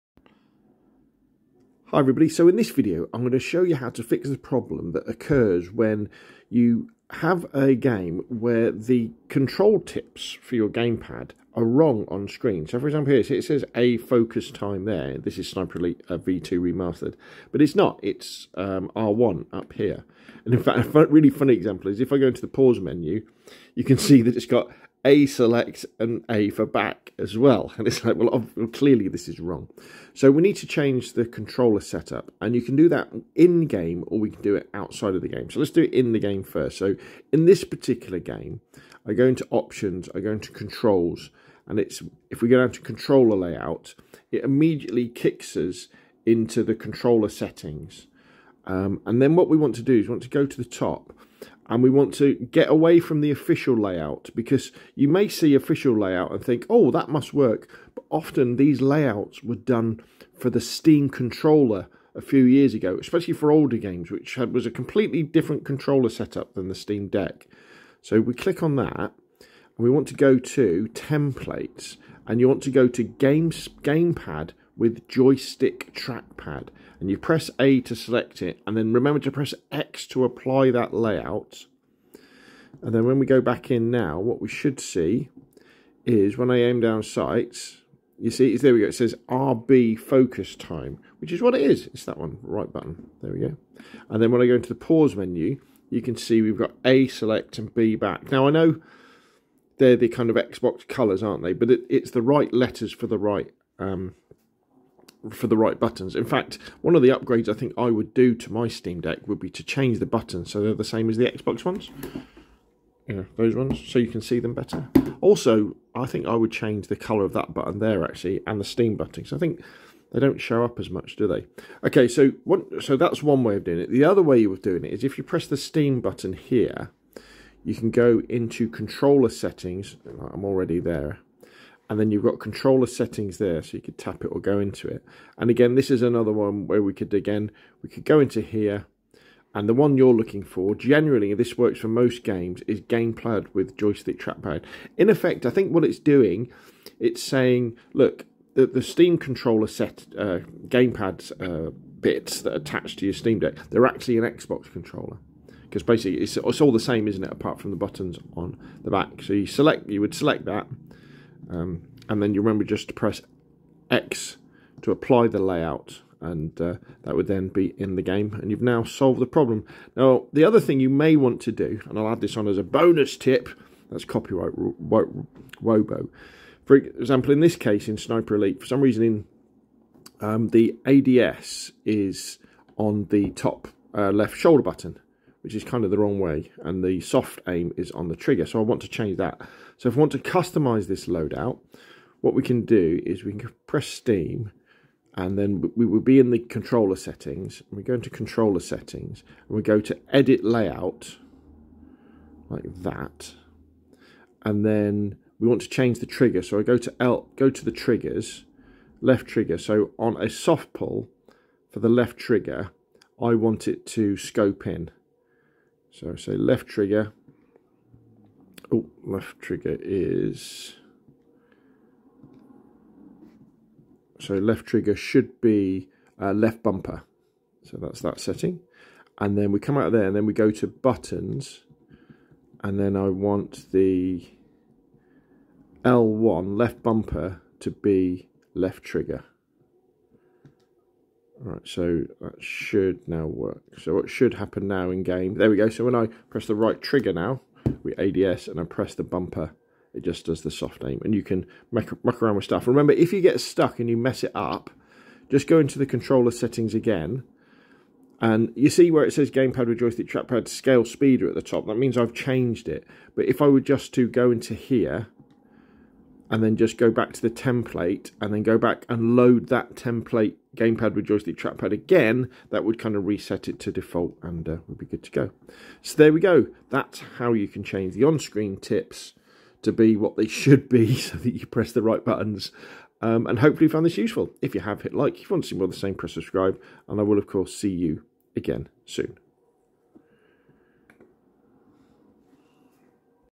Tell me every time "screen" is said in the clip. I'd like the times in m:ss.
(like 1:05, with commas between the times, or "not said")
0:12, 4:38.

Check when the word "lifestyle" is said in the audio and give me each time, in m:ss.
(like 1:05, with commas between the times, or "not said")
not said.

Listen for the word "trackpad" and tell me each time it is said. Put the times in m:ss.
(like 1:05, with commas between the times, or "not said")
1:15, 2:24, 4:20, 4:31.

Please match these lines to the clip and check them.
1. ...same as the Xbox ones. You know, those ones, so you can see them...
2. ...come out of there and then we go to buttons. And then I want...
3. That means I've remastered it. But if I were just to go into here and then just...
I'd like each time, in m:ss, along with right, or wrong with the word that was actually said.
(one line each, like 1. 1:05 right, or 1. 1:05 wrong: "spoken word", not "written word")
1. 1:50 right
2. 3:49 right
3. 4:21 wrong: "changed", not "remastered".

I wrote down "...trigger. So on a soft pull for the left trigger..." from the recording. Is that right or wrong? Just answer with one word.
right.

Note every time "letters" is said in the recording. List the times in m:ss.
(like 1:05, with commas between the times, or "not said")
1:42.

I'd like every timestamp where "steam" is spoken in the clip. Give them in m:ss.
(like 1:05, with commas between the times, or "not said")
1:00, 1:06, 1:48, 1:58, 2:05, 2:28, 2:33, 3:13.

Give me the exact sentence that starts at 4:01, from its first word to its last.
Right, so that should now work.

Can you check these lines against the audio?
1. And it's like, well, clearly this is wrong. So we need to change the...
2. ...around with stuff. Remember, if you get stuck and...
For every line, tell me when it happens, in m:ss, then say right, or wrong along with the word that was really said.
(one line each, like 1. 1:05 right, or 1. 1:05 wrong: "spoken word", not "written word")
1. 0:27 right
2. 4:12 right.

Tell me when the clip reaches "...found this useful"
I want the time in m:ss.
4:43.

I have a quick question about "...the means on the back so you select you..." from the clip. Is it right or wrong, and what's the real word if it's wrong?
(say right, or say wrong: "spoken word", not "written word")
wrong: "buttons", not "means".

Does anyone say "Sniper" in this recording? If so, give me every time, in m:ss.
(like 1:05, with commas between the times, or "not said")
0:15, 2:57.